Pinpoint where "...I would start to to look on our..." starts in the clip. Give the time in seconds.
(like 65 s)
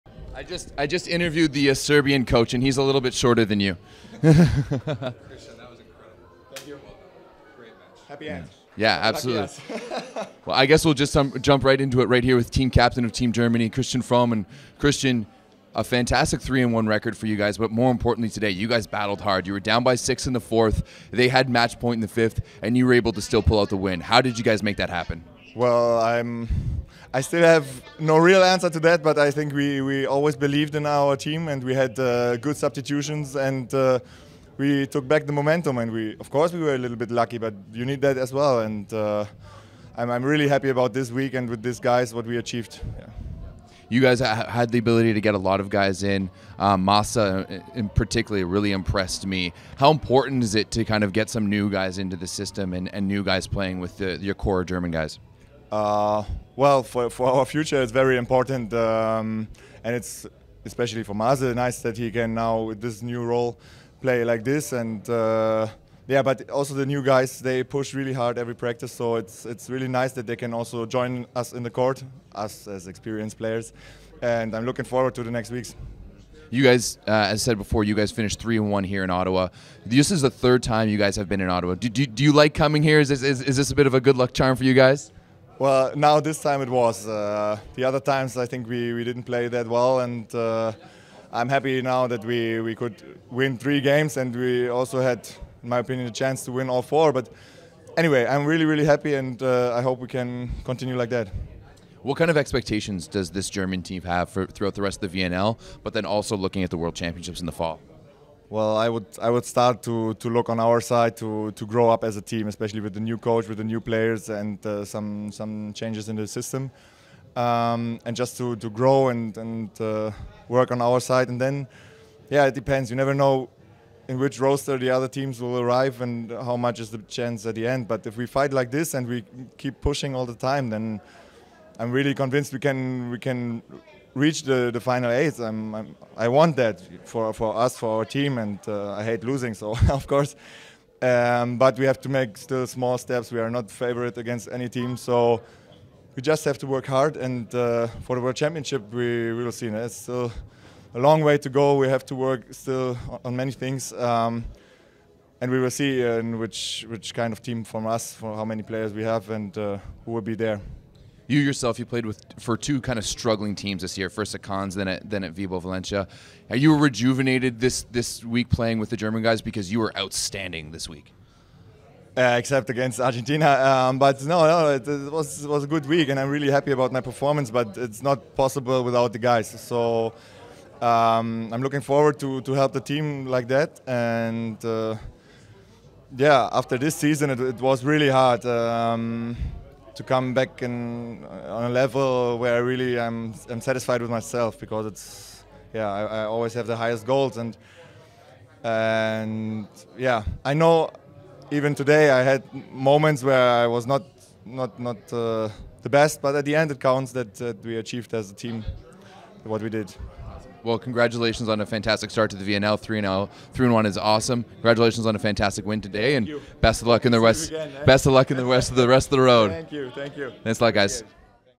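109 s.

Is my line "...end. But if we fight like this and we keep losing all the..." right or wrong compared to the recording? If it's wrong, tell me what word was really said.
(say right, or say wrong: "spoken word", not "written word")
wrong: "pushing", not "losing".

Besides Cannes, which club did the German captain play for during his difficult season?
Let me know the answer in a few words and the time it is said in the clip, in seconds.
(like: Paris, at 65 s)
Vibo Valentia, at 165 s.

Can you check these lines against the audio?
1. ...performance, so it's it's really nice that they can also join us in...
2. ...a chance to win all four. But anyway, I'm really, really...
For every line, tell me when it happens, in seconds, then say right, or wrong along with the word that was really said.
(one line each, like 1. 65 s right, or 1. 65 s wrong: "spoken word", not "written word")
1. 68 s wrong: "practice", not "performance"
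2. 96 s right.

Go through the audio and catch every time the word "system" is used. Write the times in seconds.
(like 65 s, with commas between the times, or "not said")
52 s, 116 s.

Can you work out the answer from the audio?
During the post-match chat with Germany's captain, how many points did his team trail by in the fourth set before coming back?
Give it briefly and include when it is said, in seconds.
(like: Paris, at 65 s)
6, at 19 s.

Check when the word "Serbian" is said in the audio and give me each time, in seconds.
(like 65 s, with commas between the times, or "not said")
1 s.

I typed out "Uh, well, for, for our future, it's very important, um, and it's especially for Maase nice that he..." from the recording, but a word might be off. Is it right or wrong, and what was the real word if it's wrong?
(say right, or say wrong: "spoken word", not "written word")
right.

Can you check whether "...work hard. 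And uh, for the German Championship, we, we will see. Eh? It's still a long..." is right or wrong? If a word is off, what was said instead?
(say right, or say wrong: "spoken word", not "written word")
wrong: "World", not "German".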